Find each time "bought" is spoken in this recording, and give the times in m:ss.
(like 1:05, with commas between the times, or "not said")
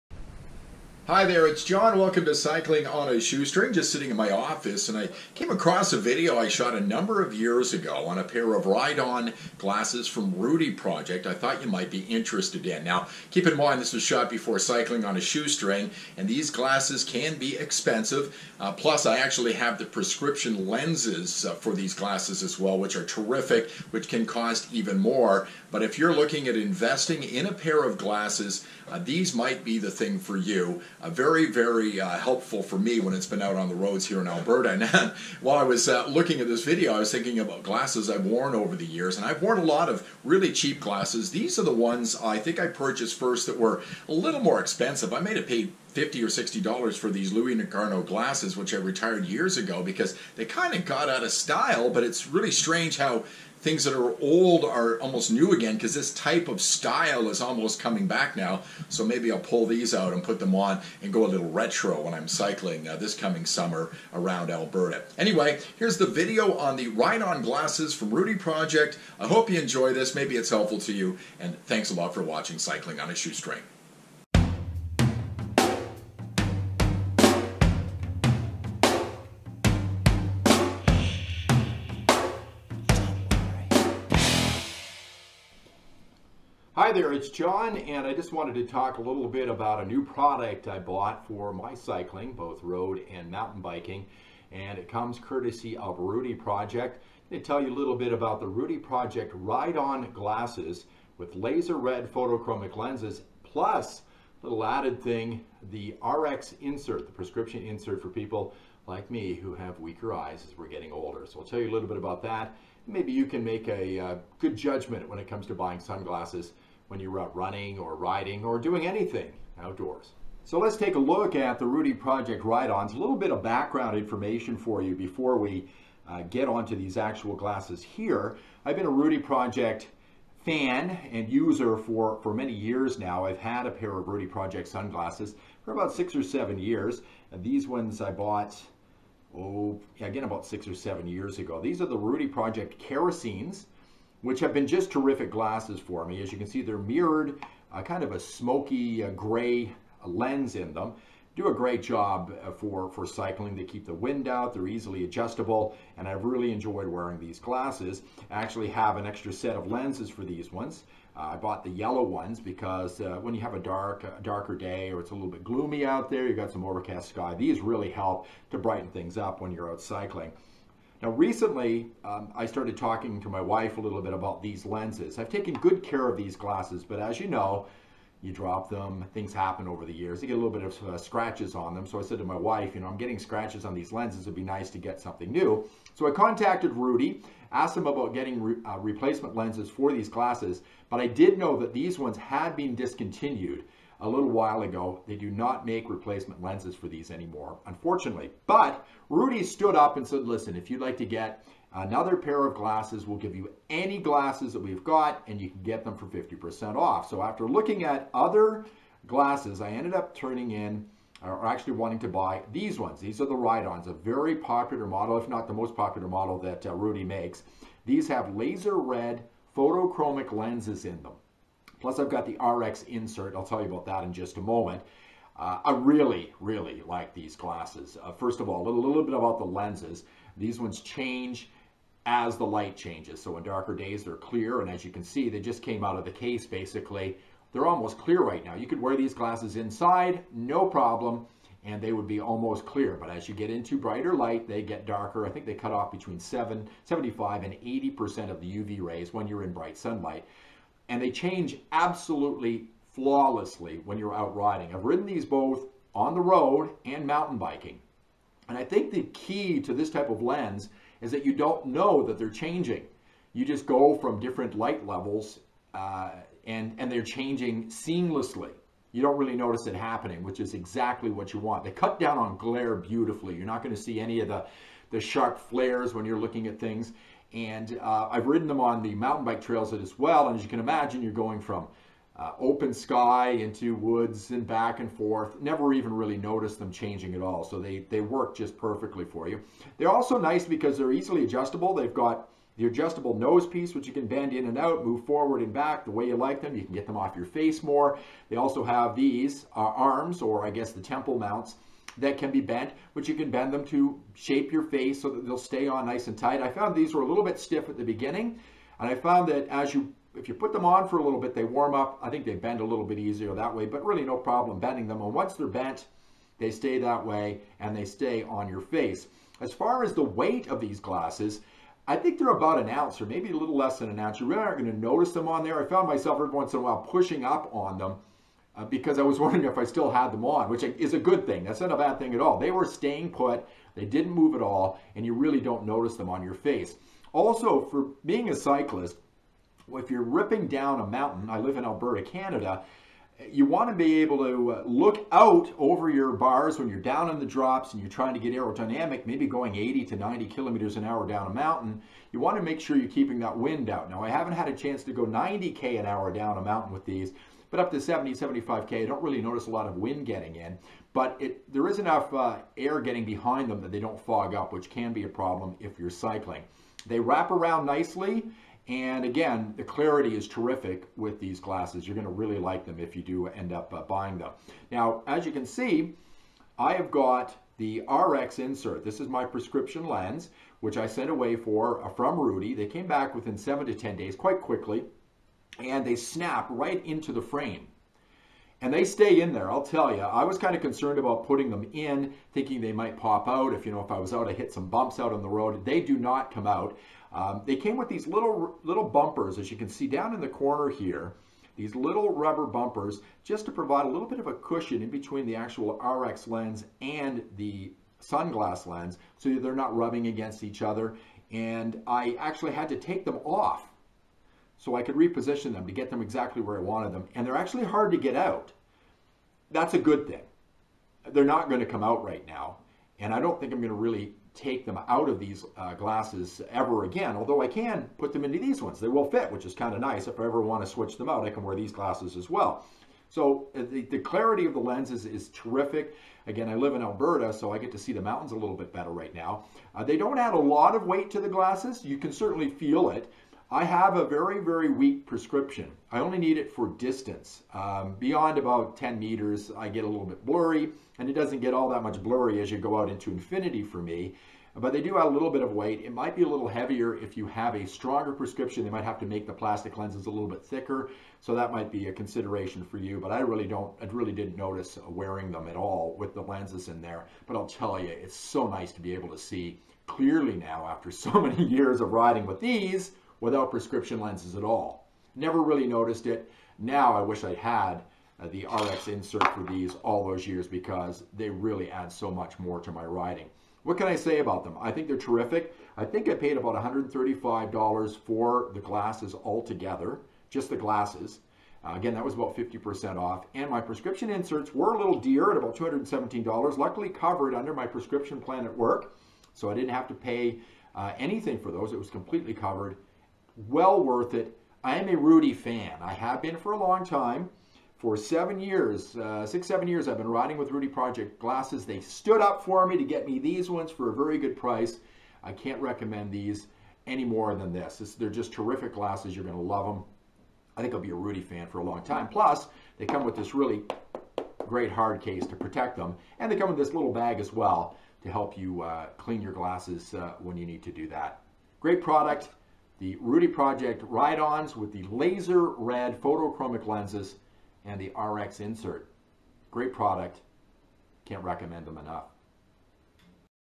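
1:30, 2:18, 2:41.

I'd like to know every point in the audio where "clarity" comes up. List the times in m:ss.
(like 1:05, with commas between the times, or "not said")
6:09, 7:13.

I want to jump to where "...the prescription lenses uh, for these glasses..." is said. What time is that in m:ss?
0:19.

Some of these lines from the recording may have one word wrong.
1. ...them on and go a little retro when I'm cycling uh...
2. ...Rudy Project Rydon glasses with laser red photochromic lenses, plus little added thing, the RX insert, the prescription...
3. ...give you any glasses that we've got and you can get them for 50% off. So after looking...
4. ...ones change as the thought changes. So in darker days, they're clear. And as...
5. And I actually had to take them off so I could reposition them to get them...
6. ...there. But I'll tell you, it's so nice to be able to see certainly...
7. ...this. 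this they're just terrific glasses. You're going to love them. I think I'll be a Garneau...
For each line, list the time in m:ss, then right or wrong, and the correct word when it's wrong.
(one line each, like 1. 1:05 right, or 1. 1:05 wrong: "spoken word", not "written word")
1. 1:00 right
2. 1:38 right
3. 3:23 right
4. 3:50 wrong: "light", not "thought"
5. 6:51 right
6. 7:46 wrong: "clearly", not "certainly"
7. 8:37 wrong: "Rudy", not "Garneau".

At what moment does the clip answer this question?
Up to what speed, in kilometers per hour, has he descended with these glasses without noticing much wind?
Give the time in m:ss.
5:58.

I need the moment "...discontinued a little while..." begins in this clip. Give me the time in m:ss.
3:12.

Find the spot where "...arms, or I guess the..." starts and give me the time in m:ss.
4:59.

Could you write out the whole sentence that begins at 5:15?
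And once they're bent, they stay that way and they stay on your face.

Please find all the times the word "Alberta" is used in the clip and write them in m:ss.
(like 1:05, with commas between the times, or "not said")
0:34, 1:04, 5:41, 7:16.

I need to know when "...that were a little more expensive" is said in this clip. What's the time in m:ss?
0:43.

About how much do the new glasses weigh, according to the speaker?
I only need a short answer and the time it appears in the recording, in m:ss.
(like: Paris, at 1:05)
About an ounce, at 5:22.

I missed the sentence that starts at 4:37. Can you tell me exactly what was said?
And uh, I've ridden them on the mountain bike trails as well.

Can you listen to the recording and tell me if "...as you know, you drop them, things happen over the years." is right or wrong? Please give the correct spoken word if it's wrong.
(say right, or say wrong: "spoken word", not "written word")
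right.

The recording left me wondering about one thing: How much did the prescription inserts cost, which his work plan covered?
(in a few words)
$217.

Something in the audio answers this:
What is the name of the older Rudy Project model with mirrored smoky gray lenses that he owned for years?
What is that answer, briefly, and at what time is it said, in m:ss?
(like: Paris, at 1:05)
Kerosenes, at 2:22.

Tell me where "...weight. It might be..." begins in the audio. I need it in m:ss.
7:35.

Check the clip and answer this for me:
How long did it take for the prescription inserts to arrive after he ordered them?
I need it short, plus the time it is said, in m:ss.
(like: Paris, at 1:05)
7 to 10 days, at 6:23.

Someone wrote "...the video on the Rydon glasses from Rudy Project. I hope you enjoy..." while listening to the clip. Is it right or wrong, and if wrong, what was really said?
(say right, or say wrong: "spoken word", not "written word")
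right.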